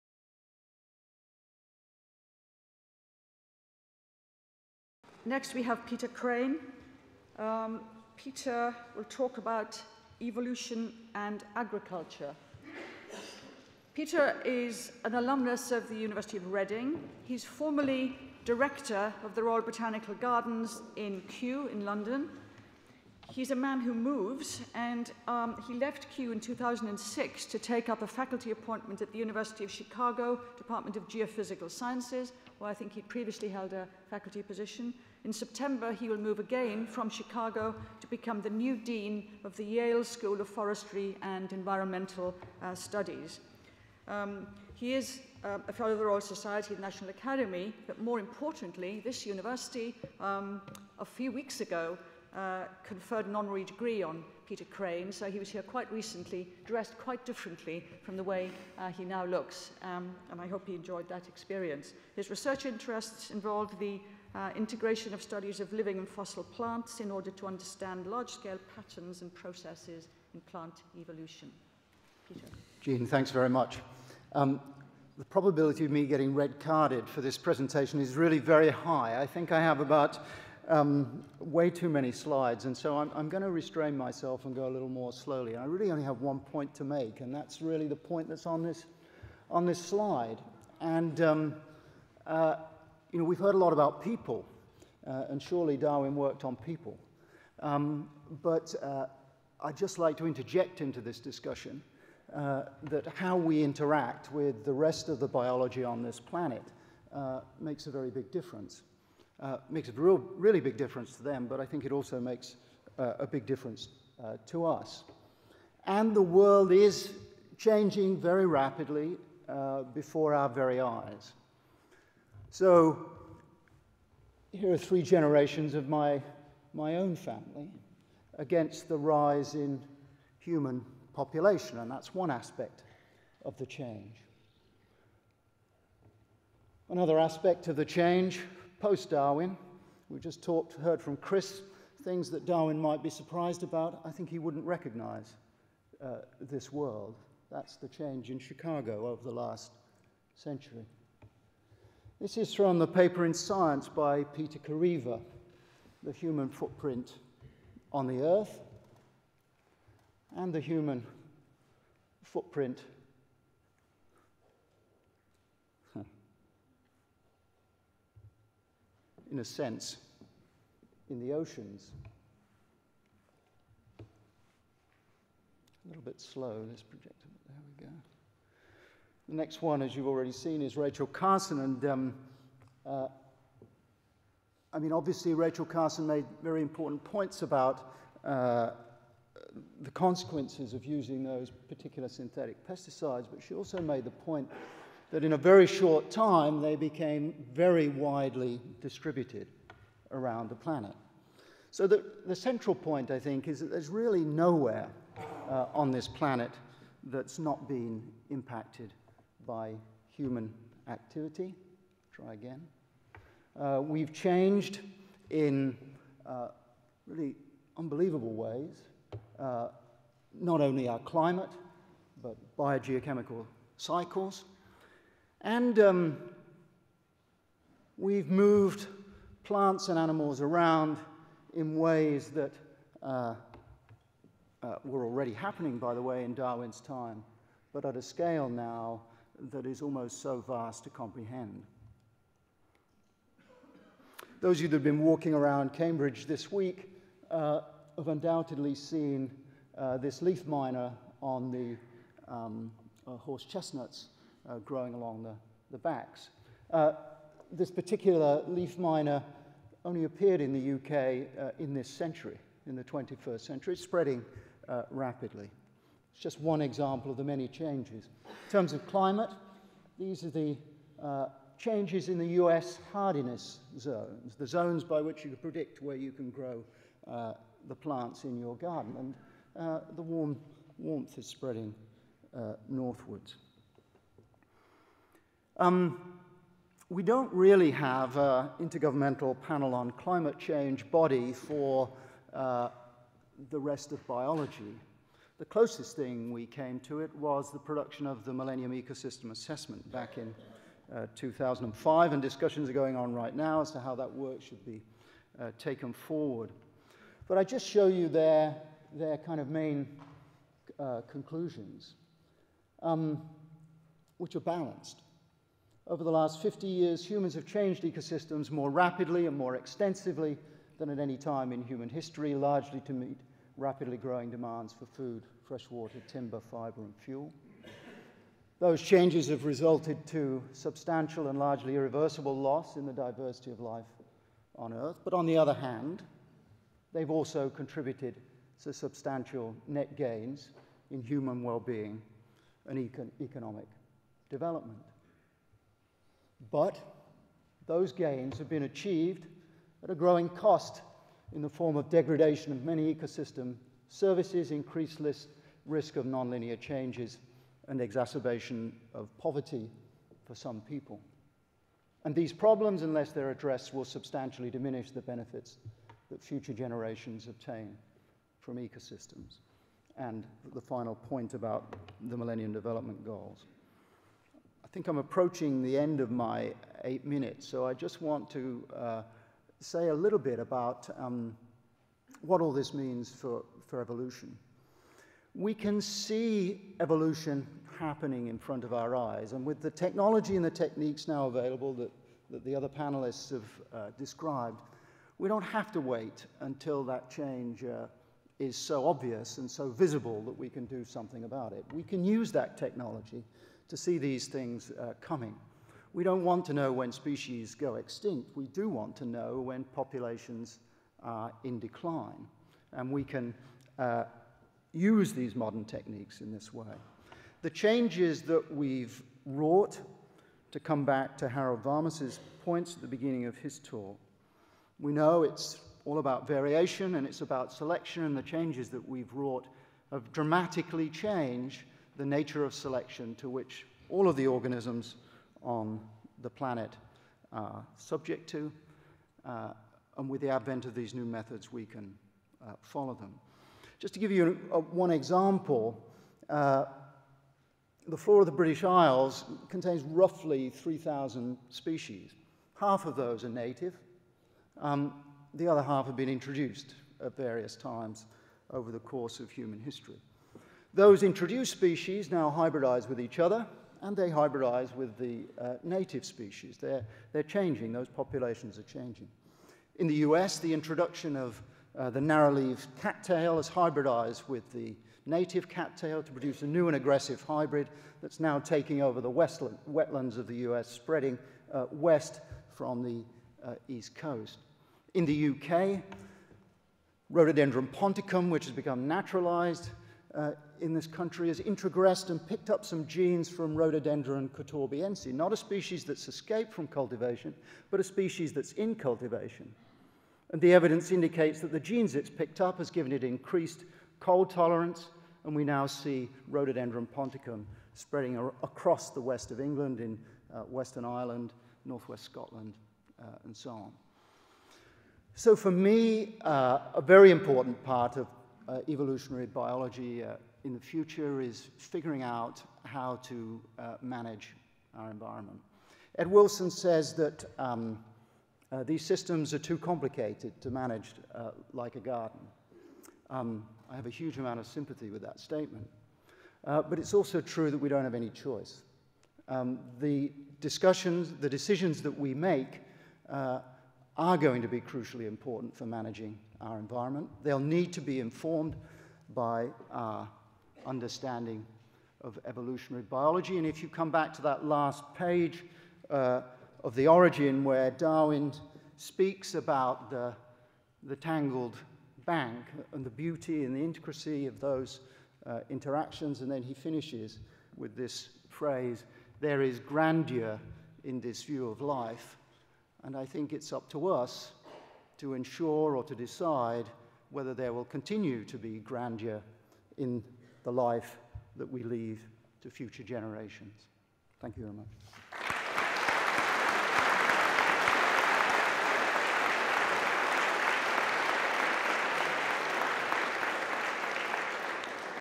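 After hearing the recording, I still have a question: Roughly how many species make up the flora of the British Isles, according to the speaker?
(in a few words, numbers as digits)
3,000.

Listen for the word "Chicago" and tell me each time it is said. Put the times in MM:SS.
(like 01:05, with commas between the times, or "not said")
00:29, 00:37, 02:28.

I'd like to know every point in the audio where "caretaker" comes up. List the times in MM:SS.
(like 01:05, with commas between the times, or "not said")
not said.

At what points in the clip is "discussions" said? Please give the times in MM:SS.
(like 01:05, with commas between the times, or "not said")
01:41, 05:02, 09:00.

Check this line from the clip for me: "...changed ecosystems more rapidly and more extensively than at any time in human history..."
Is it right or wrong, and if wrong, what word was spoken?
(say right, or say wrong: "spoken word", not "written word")
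right.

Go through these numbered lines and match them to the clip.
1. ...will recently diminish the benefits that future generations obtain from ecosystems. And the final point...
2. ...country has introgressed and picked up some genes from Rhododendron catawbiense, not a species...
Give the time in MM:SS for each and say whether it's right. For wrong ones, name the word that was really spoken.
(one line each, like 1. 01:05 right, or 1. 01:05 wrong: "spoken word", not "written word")
1. 06:03 wrong: "substantially", not "recently"
2. 08:10 right.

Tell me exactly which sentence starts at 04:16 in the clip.
Uh, this particular leaf miner only appeared in the UK uh, in this century, in the 21st century.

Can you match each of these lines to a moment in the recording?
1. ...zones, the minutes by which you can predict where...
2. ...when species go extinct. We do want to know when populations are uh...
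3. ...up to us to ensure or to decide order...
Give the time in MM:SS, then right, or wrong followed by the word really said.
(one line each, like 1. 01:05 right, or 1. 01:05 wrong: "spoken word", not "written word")
1. 04:33 wrong: "zones", not "minutes"
2. 06:46 right
3. 09:33 wrong: "whether", not "order".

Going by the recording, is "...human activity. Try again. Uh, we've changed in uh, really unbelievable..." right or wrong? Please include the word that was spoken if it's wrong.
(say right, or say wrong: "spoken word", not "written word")
right.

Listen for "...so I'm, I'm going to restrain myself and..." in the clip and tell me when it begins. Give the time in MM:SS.
01:22.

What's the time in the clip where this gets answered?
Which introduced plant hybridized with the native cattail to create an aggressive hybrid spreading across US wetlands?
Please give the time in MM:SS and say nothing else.
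07:52.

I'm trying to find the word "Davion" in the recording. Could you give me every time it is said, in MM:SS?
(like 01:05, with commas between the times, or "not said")
not said.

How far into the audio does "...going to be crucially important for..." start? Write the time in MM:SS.
09:04.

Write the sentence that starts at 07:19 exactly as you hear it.
Uh, and with the advent of these new methods, we can uh, follow them.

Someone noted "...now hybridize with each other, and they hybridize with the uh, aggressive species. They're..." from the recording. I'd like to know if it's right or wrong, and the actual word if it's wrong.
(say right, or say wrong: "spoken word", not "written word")
wrong: "native", not "aggressive".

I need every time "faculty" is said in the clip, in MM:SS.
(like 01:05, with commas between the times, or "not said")
00:28, 00:34.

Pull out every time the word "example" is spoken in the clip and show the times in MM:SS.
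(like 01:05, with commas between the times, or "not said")
04:26, 07:24.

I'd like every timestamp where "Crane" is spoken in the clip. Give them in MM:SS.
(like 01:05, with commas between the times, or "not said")
00:06, 00:54.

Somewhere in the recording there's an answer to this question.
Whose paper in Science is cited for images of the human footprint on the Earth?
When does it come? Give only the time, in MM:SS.
02:34.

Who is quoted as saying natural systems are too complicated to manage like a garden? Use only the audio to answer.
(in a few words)
Ed Wilson.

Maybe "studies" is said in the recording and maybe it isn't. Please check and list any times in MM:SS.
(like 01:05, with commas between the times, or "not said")
00:42, 01:05.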